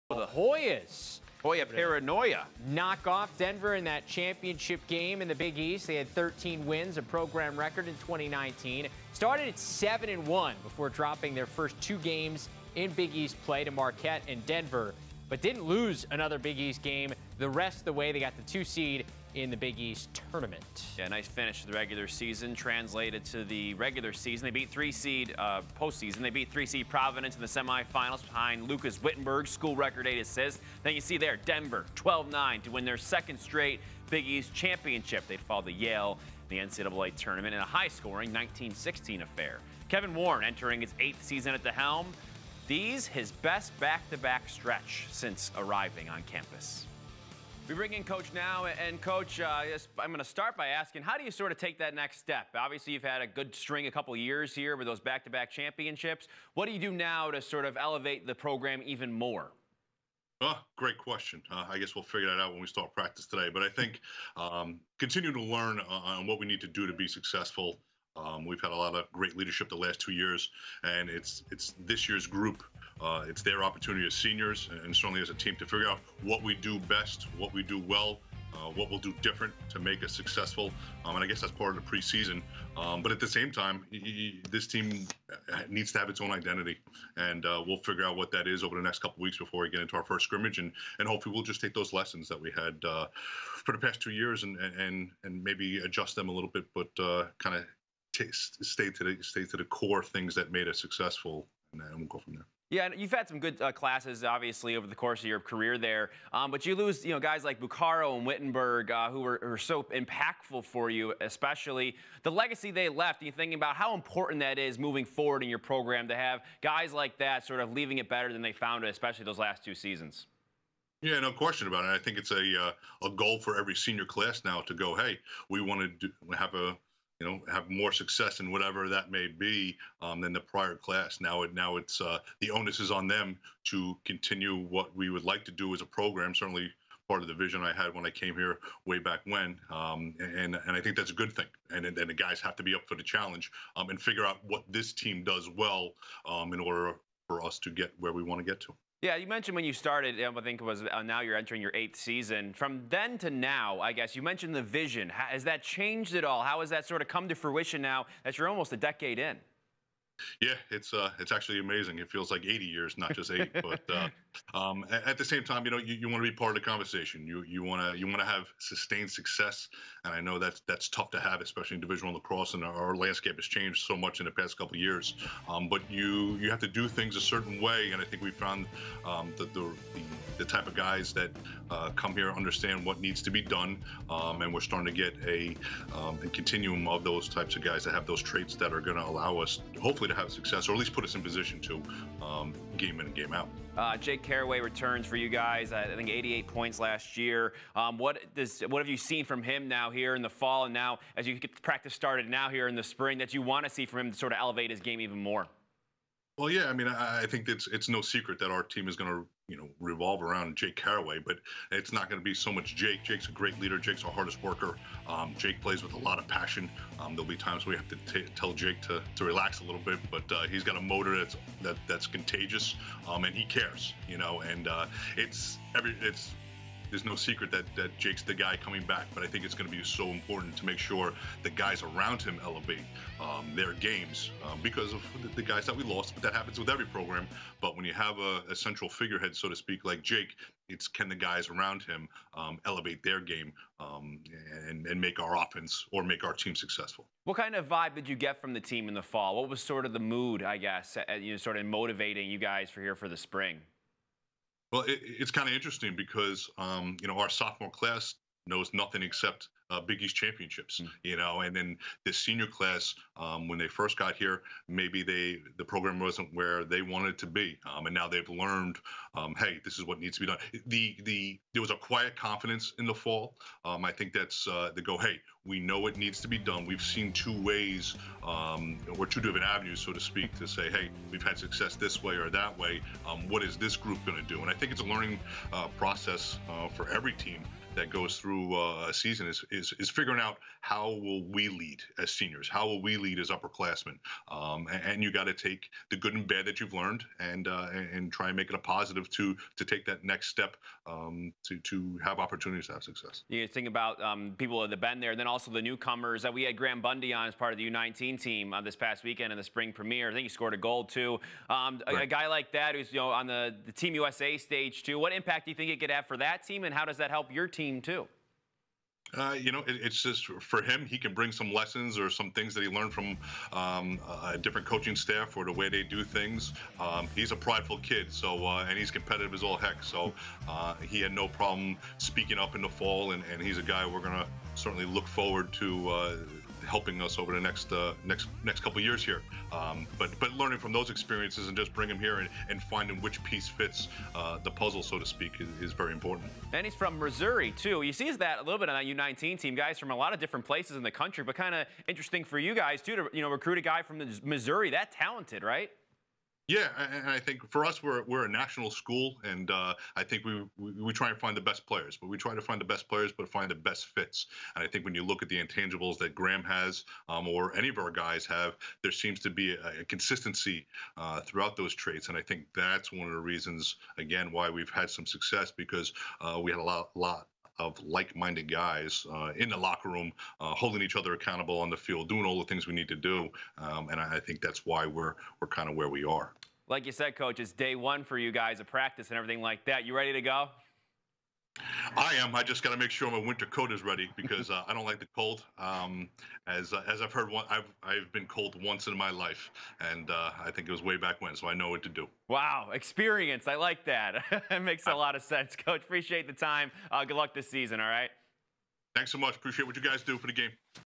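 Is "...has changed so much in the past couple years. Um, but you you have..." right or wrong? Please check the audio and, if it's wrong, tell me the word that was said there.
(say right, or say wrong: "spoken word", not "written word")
right.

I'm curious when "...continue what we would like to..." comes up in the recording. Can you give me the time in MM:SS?
02:14.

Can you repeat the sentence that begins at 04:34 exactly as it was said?
Hey, we know it needs to be done.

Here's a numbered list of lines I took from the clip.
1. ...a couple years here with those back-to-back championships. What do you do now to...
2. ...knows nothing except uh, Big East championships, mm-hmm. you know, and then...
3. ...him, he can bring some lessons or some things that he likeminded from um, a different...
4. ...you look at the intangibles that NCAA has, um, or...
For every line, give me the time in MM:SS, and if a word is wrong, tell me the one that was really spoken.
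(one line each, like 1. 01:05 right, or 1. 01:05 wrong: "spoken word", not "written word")
1. 00:53 right
2. 04:18 right
3. 05:20 wrong: "learned", not "likeminded"
4. 06:04 wrong: "Graham", not "NCAA".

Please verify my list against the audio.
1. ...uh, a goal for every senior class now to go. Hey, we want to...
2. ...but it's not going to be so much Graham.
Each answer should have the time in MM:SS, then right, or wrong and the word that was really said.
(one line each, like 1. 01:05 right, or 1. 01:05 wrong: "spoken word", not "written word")
1. 02:02 right
2. 03:31 wrong: "Jake", not "Graham".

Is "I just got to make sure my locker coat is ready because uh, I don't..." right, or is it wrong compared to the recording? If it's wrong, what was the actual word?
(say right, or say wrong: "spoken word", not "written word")
wrong: "winter", not "locker".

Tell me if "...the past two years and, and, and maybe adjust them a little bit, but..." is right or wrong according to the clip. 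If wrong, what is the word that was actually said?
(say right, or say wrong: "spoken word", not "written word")
right.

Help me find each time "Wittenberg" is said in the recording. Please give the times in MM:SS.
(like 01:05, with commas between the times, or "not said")
00:29, 01:48.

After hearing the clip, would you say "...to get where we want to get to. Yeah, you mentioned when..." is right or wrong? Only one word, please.
right.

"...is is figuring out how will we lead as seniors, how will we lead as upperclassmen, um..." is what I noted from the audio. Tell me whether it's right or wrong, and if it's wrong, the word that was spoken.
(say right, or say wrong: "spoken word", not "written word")
right.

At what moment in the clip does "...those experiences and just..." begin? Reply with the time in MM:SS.
05:40.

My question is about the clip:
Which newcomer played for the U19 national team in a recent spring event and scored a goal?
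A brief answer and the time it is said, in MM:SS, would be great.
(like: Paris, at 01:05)
Graham Bundy, at 05:06.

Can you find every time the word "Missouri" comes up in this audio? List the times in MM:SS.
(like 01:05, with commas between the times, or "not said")
05:46, 05:54.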